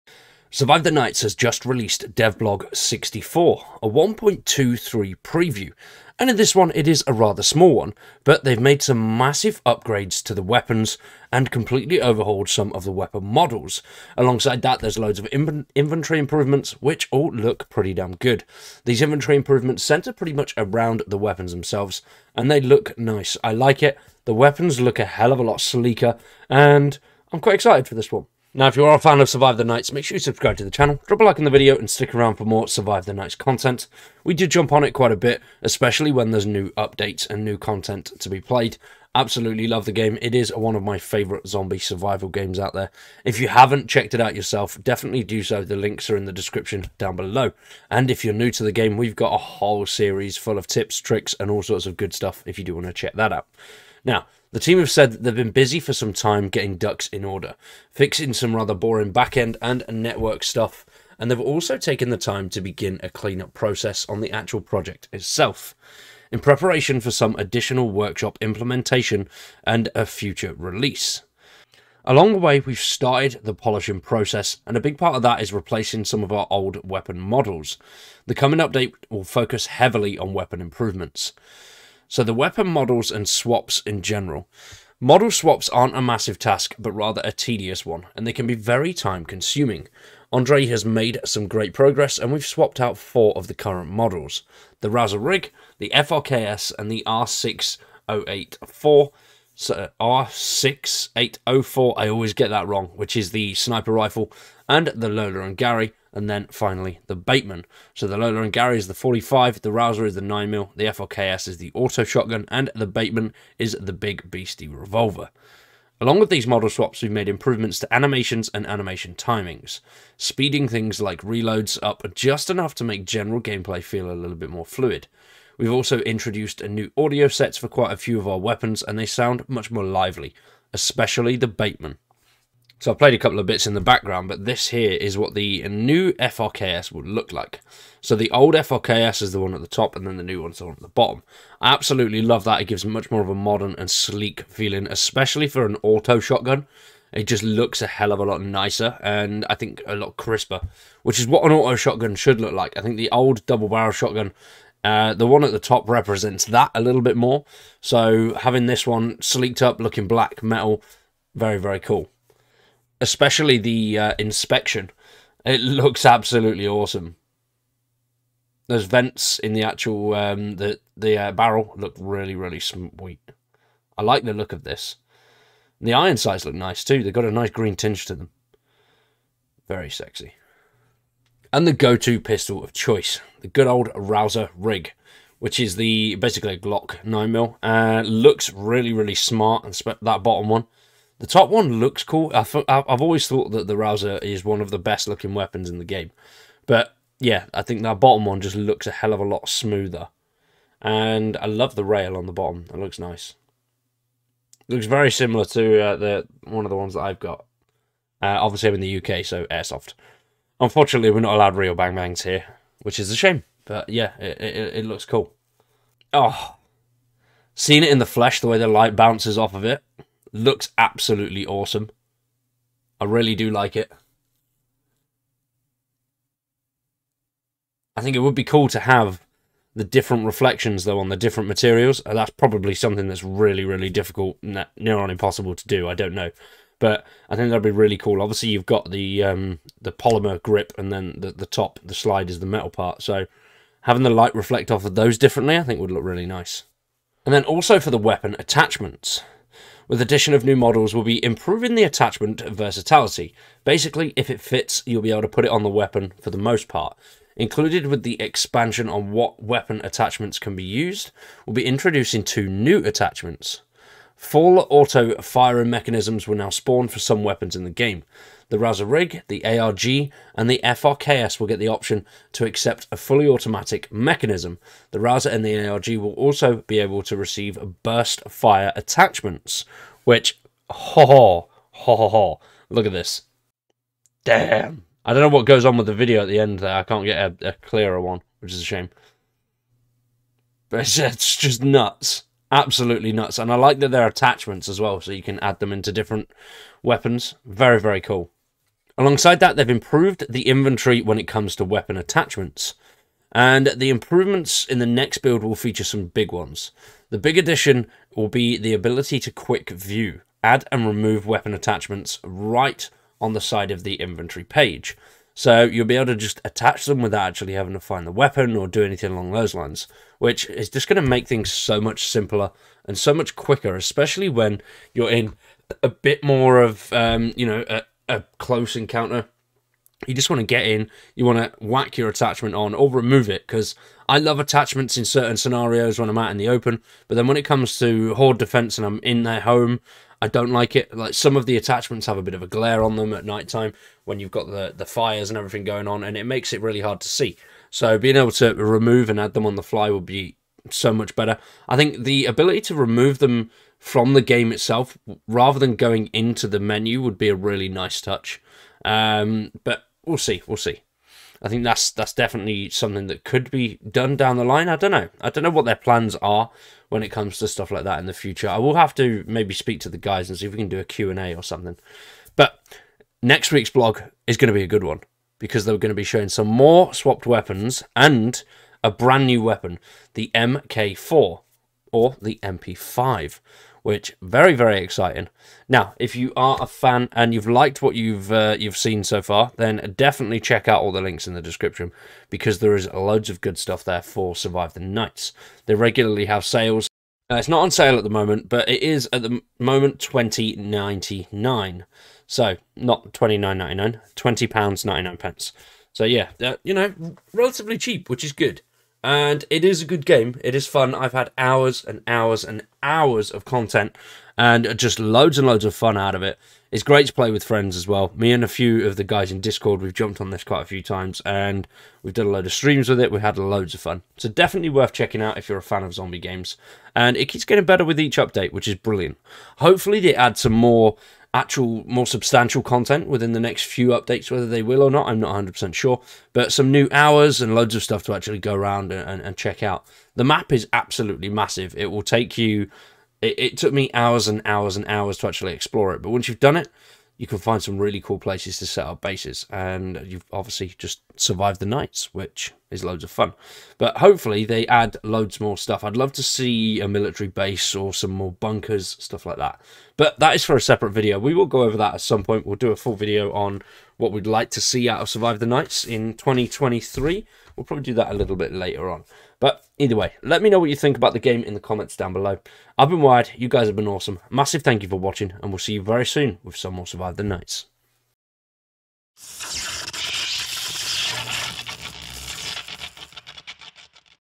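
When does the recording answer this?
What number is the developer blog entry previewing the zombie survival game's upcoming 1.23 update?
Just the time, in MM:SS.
00:02.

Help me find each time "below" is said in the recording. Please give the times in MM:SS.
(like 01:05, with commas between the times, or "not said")
00:47, 07:52.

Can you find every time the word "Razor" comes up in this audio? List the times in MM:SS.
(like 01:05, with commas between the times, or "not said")
04:28, 04:34.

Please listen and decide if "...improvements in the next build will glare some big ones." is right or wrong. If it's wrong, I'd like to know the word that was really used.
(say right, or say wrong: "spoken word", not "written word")
wrong: "feature", not "glare".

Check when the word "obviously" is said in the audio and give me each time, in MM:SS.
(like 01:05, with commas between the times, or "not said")
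03:28, 03:58, 07:30.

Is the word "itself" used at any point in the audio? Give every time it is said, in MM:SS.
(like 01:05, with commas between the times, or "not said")
01:05, 05:54.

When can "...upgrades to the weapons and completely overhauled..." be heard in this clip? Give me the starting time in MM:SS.
00:09.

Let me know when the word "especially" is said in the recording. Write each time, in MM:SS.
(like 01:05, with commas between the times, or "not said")
00:35, 02:10, 02:24, 02:42, 05:23.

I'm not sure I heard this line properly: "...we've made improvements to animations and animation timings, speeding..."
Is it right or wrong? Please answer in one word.
right.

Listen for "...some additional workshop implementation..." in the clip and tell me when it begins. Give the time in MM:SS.
01:07.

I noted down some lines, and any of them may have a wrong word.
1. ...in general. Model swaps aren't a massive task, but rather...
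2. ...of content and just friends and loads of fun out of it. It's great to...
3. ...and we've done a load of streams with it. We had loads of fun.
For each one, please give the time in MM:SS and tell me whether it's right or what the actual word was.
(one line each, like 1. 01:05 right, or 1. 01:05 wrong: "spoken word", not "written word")
1. 01:23 right
2. 06:53 wrong: "loads", not "friends"
3. 07:01 right.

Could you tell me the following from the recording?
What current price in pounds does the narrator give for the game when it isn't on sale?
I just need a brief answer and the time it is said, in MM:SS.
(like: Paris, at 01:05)
£20.99, at 06:39.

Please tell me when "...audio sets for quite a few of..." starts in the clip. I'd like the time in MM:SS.
02:06.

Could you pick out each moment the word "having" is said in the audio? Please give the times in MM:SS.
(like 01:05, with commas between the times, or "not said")
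02:38, 04:03, 05:17.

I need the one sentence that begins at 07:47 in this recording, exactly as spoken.
We'll probably do that a little bit later on.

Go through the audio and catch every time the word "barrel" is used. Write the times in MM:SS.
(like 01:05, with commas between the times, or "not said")
02:33, 02:51.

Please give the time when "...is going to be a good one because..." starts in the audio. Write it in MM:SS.
06:14.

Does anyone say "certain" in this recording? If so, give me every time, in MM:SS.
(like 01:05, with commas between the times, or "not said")
05:35.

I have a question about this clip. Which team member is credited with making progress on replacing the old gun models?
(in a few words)
Andre.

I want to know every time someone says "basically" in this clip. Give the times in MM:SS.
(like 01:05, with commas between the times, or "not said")
03:06, 04:13.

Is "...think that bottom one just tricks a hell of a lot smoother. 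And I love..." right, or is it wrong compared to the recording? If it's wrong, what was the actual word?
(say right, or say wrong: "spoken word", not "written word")
wrong: "looks", not "tricks".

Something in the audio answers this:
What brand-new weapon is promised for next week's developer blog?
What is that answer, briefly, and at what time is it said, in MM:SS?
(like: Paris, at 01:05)
MP5, at 06:22.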